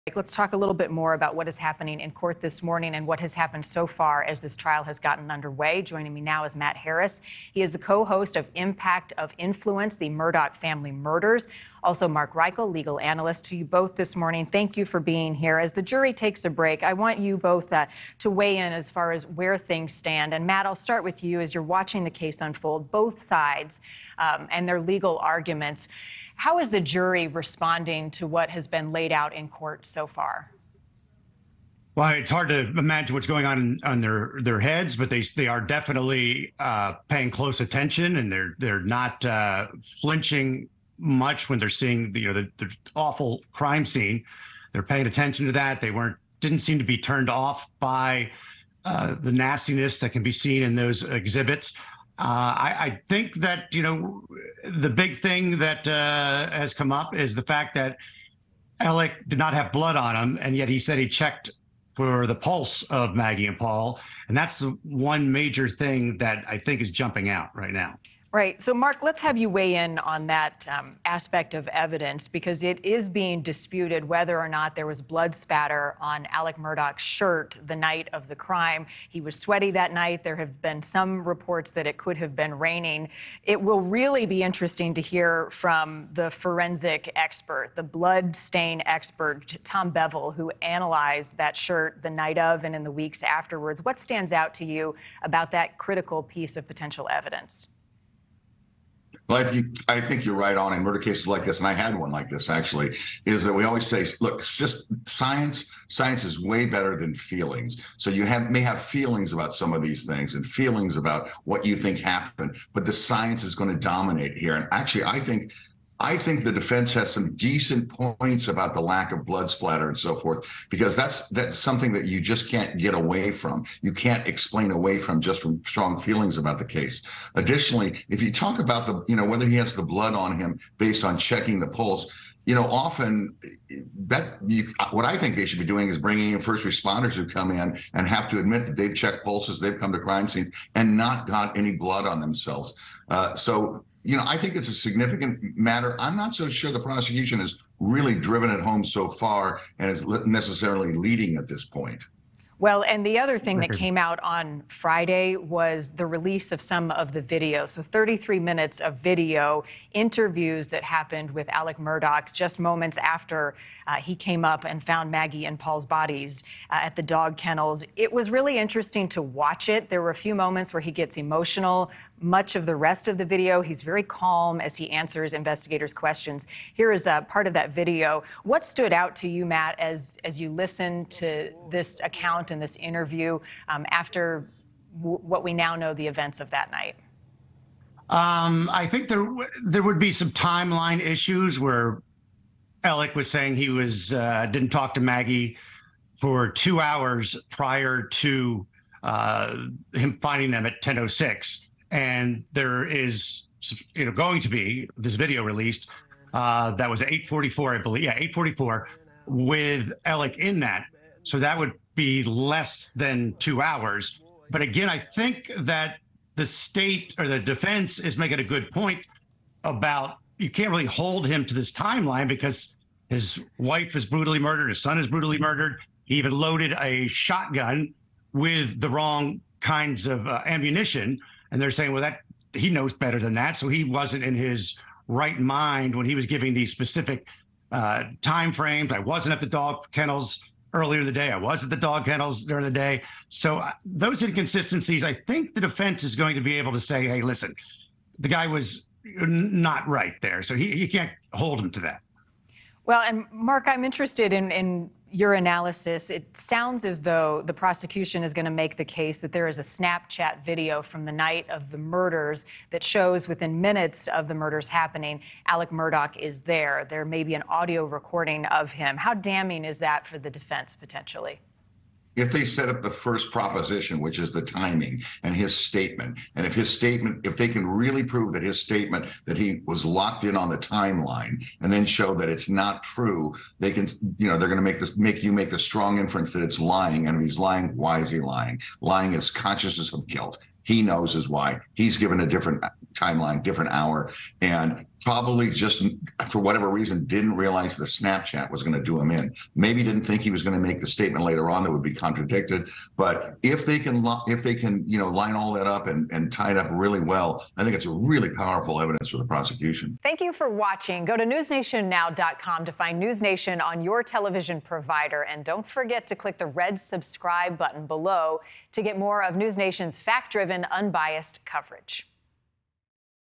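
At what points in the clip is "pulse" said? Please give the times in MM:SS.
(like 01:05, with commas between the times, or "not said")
01:02, 02:11, 02:19.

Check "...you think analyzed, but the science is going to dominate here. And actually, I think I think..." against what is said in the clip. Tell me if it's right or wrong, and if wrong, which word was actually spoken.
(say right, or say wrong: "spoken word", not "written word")
wrong: "happened", not "analyzed".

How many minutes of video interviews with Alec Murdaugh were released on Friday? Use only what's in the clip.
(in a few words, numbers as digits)
33.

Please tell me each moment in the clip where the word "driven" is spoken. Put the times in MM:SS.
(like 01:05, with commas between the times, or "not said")
02:28, 05:19.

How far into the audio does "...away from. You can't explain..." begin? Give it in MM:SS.
02:02.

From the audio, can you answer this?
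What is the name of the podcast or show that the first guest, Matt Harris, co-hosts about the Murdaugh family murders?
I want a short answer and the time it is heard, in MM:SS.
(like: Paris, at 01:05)
Impact of Influence, at 00:08.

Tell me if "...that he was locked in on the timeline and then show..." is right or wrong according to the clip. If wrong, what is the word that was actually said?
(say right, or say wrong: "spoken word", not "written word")
right.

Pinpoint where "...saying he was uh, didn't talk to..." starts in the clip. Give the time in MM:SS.
03:13.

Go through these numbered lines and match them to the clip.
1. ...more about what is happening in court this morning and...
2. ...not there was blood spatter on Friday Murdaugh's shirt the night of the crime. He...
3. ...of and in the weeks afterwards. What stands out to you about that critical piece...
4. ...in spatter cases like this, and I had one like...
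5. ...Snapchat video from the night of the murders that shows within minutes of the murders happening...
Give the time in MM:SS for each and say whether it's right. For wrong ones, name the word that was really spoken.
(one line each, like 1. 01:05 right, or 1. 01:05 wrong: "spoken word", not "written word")
1. 00:00 right
2. 01:14 wrong: "Alec", not "Friday"
3. 01:32 right
4. 01:40 wrong: "murder", not "spatter"
5. 04:19 right.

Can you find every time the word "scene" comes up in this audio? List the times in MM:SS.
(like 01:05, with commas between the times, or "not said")
00:43, 02:20.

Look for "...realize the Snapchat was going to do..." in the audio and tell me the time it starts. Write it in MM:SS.
04:57.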